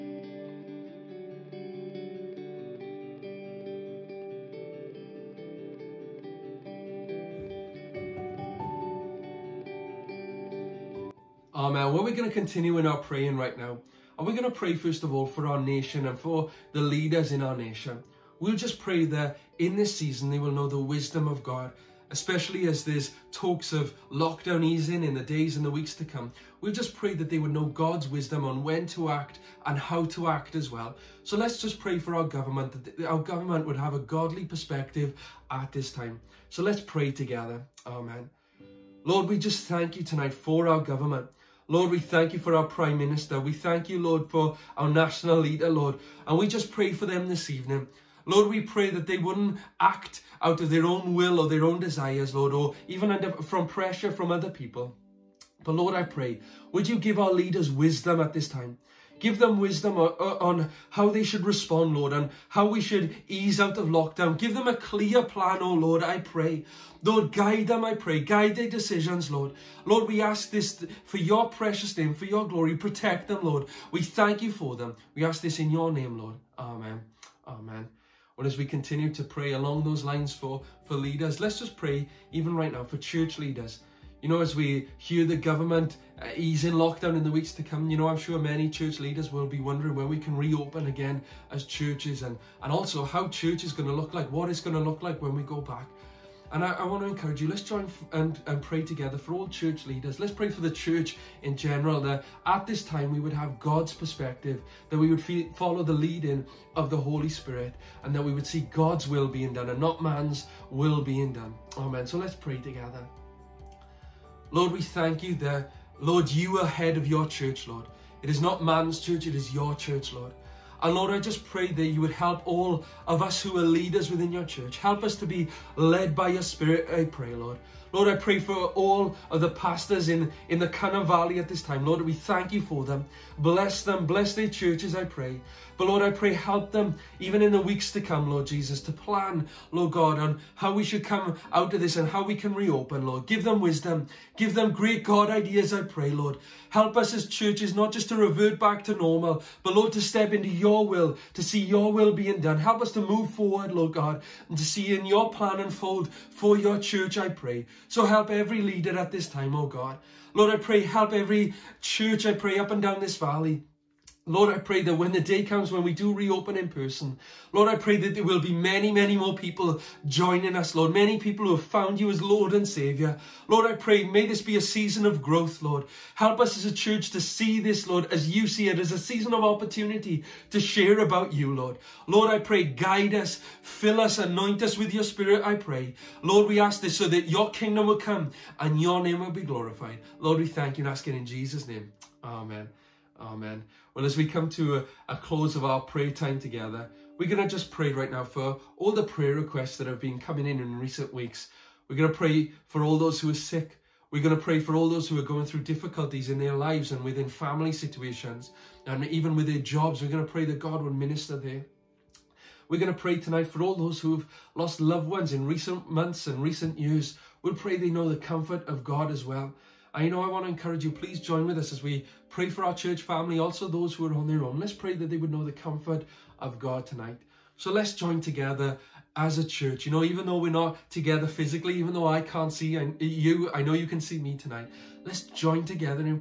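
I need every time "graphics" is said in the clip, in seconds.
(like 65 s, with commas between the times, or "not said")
not said.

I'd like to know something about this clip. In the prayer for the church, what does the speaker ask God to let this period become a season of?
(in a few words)
growth.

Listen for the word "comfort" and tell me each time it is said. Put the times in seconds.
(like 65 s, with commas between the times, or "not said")
218 s, 225 s.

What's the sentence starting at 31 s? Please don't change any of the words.
So let's just pray for our government, that our government would have a godly perspective at this time.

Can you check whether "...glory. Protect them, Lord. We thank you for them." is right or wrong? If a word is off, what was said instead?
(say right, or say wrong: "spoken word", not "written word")
right.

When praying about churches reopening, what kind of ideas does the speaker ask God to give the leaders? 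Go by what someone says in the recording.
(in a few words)
great God ideas.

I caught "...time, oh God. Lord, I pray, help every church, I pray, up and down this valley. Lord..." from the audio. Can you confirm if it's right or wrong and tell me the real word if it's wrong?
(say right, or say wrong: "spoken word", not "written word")
right.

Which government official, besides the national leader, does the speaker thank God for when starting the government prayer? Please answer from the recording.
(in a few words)
Prime Minister.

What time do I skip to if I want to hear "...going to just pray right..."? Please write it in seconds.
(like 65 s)
197 s.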